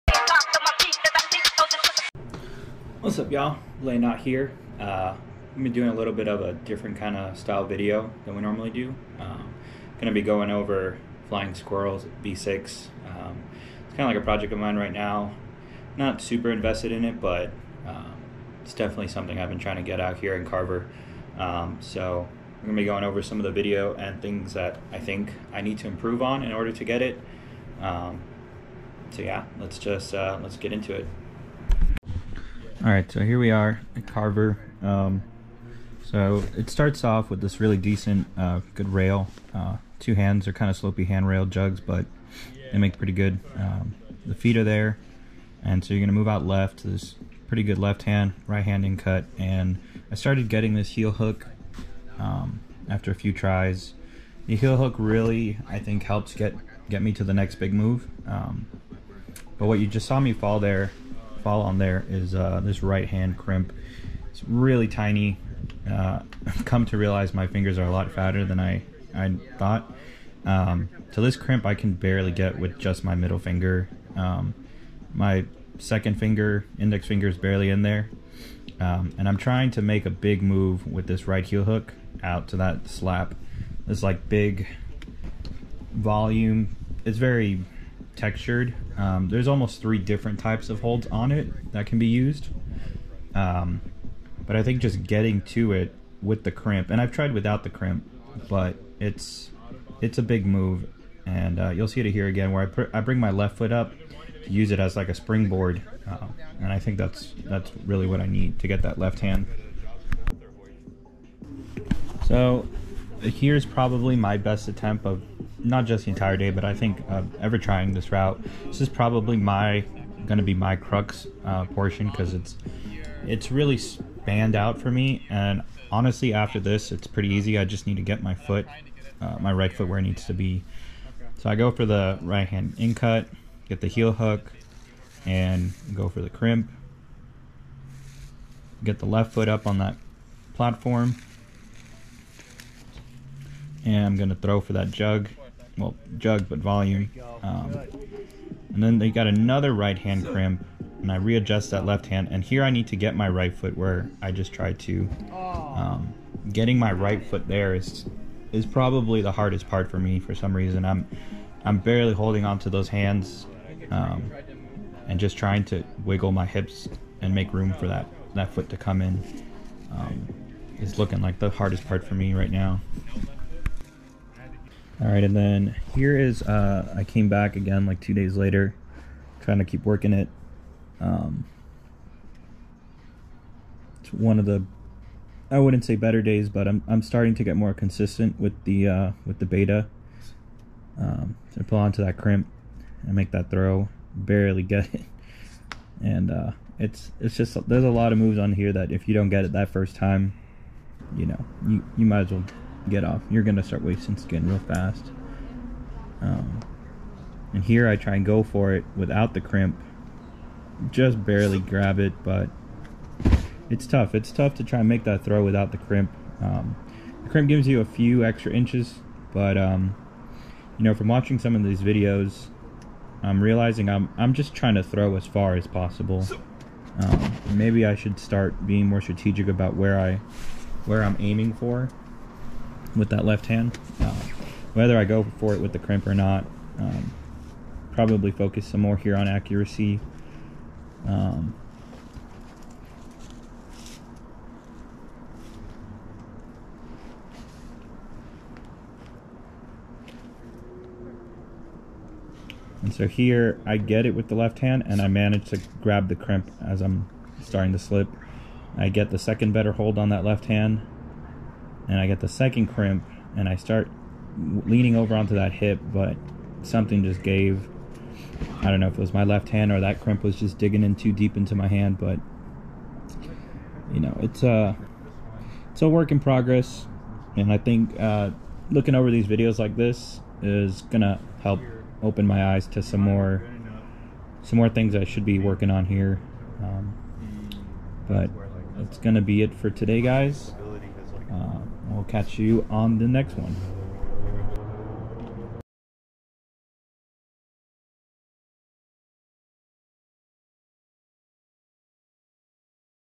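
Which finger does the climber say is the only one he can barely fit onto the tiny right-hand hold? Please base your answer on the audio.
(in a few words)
middle finger.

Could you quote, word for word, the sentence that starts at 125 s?
And honestly, after this, it's pretty easy.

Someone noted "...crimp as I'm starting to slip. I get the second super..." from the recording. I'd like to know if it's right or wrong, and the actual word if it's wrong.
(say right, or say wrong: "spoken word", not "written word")
wrong: "better", not "super".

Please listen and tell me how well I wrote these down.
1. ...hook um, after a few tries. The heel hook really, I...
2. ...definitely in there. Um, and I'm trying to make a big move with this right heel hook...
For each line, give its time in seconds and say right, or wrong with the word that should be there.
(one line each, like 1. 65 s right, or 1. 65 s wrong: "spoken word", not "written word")
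1. 51 s right
2. 77 s wrong: "barely", not "definitely".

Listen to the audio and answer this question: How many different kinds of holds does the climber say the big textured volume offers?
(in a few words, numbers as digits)
3.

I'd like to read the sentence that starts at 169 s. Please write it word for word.
Um, is looking like the hardest part for me right now.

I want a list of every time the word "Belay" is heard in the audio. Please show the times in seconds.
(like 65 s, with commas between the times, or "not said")
3 s.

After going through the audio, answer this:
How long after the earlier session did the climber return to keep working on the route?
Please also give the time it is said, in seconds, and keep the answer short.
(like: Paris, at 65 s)
2 days later, at 178 s.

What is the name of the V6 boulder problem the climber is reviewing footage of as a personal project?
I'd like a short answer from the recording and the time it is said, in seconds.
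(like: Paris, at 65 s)
Flying Squirrels, at 11 s.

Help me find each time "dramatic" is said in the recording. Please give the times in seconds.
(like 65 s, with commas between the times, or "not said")
not said.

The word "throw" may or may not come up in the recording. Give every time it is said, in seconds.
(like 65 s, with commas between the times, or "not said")
144 s, 193 s, 215 s, 224 s.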